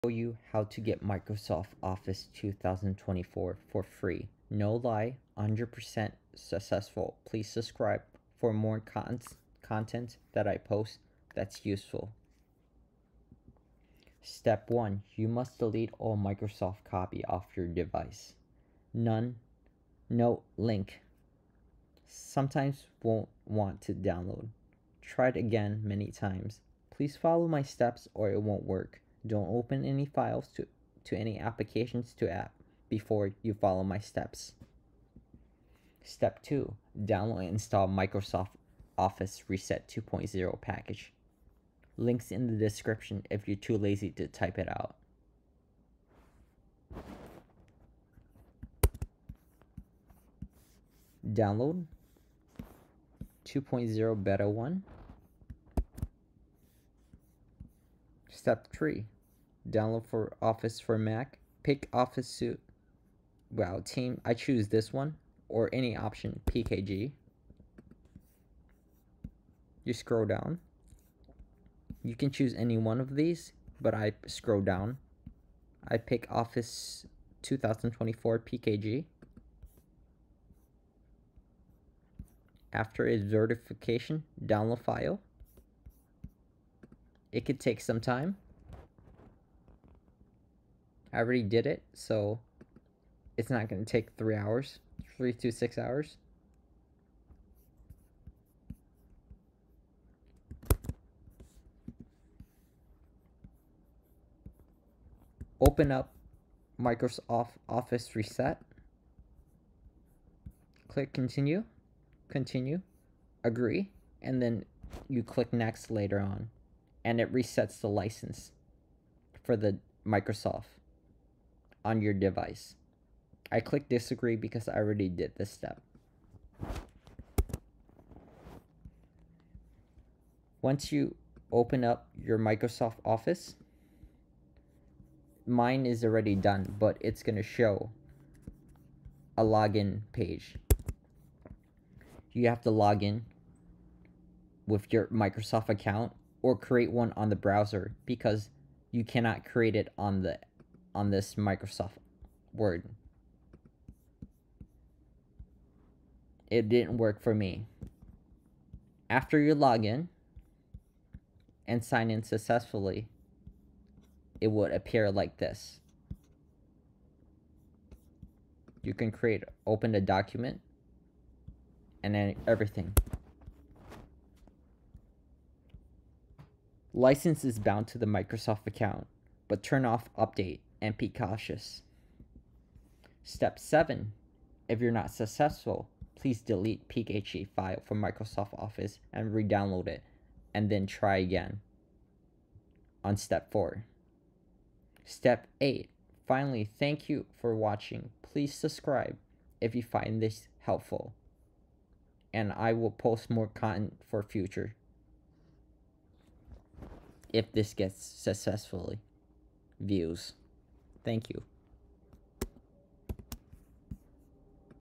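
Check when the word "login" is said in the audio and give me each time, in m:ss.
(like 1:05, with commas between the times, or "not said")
2:19.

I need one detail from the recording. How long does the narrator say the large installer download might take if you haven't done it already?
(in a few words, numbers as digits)
3 to 6 hours.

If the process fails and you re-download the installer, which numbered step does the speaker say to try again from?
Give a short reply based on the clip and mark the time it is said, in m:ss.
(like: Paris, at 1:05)
Step 4, at 3:13.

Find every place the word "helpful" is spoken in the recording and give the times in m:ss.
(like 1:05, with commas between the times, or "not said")
3:20.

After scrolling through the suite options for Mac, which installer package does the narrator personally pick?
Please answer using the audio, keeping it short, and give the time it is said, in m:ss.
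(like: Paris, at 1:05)
Office 2024 PKG, at 1:16.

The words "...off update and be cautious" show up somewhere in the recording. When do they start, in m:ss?
2:59.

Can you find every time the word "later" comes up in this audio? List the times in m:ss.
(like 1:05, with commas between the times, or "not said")
1:55.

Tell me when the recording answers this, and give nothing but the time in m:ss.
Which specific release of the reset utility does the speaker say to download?
0:53.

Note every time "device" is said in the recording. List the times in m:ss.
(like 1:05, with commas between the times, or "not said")
0:17, 2:02.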